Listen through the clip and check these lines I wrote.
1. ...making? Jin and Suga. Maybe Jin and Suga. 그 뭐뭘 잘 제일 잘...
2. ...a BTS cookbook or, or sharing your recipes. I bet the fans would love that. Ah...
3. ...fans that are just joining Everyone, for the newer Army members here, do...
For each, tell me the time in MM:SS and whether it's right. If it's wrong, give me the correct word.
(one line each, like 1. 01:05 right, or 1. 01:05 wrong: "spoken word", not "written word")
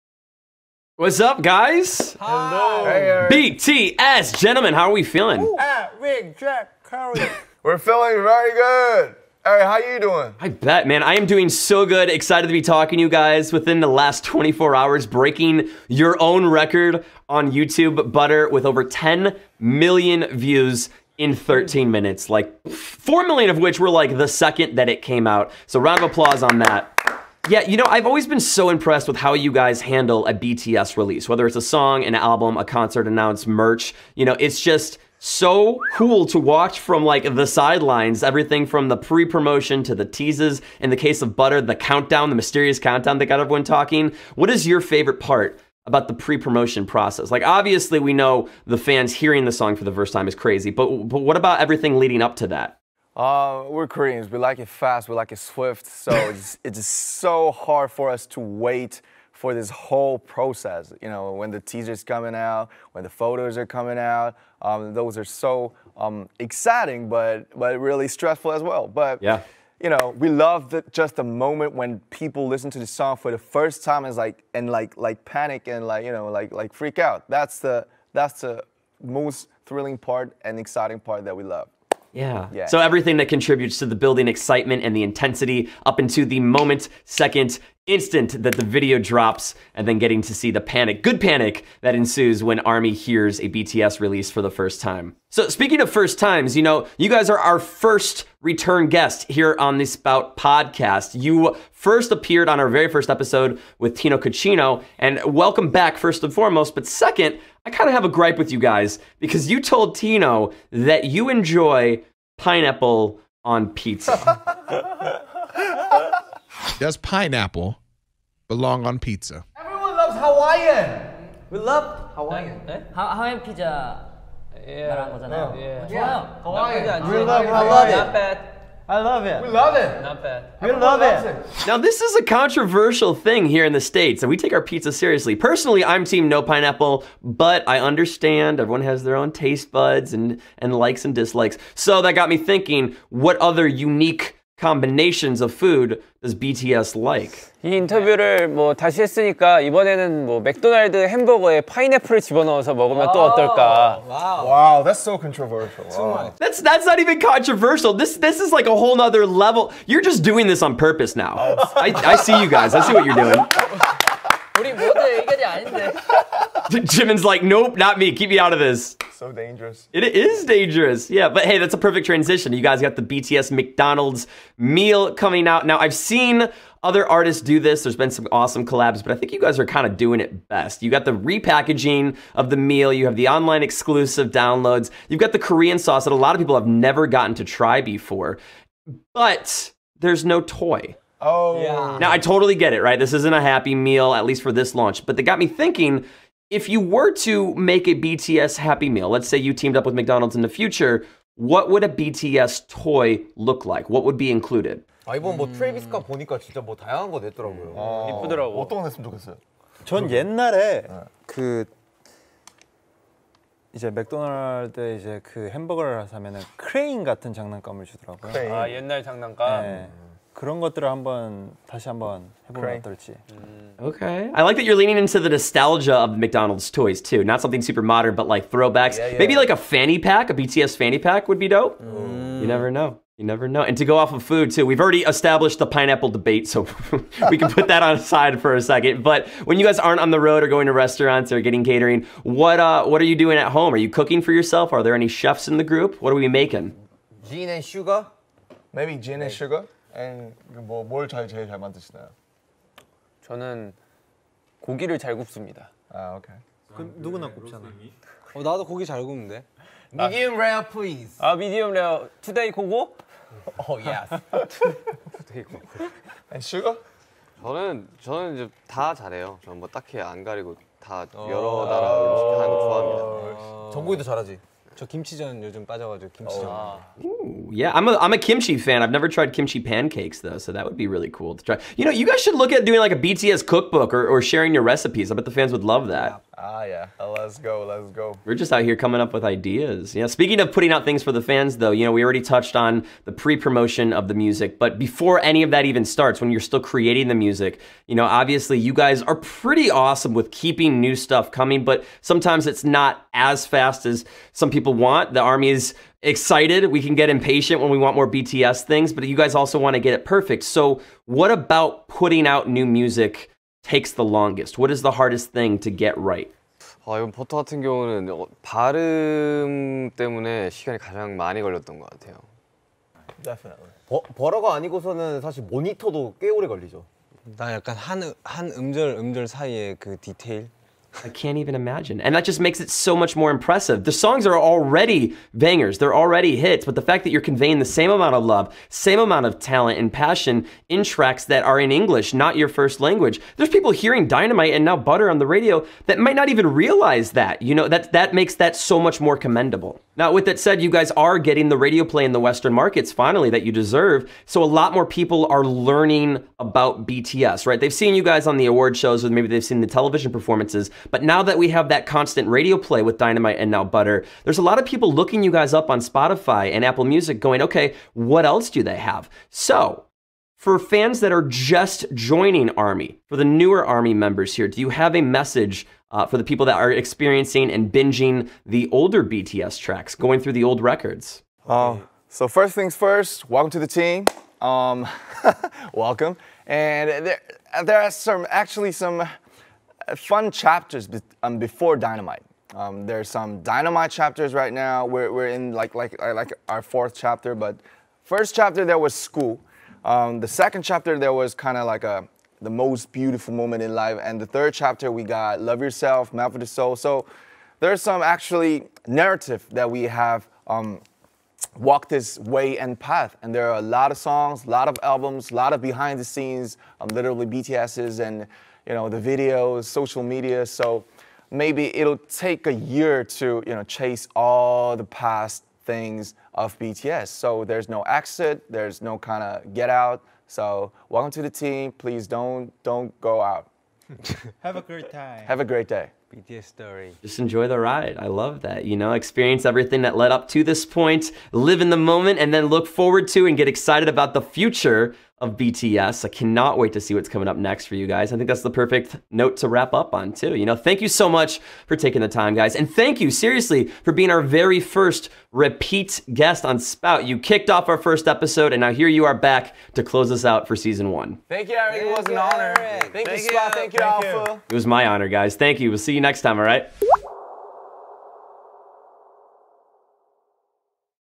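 1. 04:06 right
2. 04:42 right
3. 06:10 wrong: "Army", not "Everyone".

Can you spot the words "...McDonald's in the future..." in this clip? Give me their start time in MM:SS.
03:19.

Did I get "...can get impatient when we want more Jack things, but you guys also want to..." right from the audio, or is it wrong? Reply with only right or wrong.
wrong.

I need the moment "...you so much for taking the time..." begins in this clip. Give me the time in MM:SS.
07:30.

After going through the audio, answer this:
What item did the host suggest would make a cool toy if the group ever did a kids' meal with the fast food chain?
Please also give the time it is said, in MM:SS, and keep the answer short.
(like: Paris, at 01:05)
A fanny pack, at 03:50.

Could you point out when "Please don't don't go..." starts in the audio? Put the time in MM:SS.
07:11.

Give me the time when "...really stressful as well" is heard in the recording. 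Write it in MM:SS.
01:07.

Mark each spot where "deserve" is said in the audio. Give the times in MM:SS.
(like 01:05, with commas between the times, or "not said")
05:53.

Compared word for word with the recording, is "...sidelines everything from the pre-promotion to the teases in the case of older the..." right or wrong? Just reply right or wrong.
wrong.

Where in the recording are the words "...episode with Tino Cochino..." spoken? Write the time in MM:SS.
01:43.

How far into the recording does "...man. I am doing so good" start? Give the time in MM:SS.
00:10.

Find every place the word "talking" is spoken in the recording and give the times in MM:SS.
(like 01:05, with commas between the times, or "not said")
00:12, 00:43.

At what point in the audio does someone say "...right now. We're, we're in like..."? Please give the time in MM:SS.
06:34.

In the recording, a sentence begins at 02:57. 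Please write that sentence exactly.
There's been some awesome collabs, but I think you guys are kind of doing it best.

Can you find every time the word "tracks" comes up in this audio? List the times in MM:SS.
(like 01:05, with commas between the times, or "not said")
05:40, 06:19.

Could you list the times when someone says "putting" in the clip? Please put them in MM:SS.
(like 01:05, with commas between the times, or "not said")
04:50, 05:11.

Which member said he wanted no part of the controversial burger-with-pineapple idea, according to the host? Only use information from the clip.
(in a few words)
Jimin.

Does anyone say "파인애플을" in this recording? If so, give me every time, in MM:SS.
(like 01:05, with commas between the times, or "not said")
02:31.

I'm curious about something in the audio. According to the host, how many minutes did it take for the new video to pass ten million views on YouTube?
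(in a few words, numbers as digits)
13.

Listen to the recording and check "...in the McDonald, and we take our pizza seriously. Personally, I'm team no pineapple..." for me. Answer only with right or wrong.
wrong.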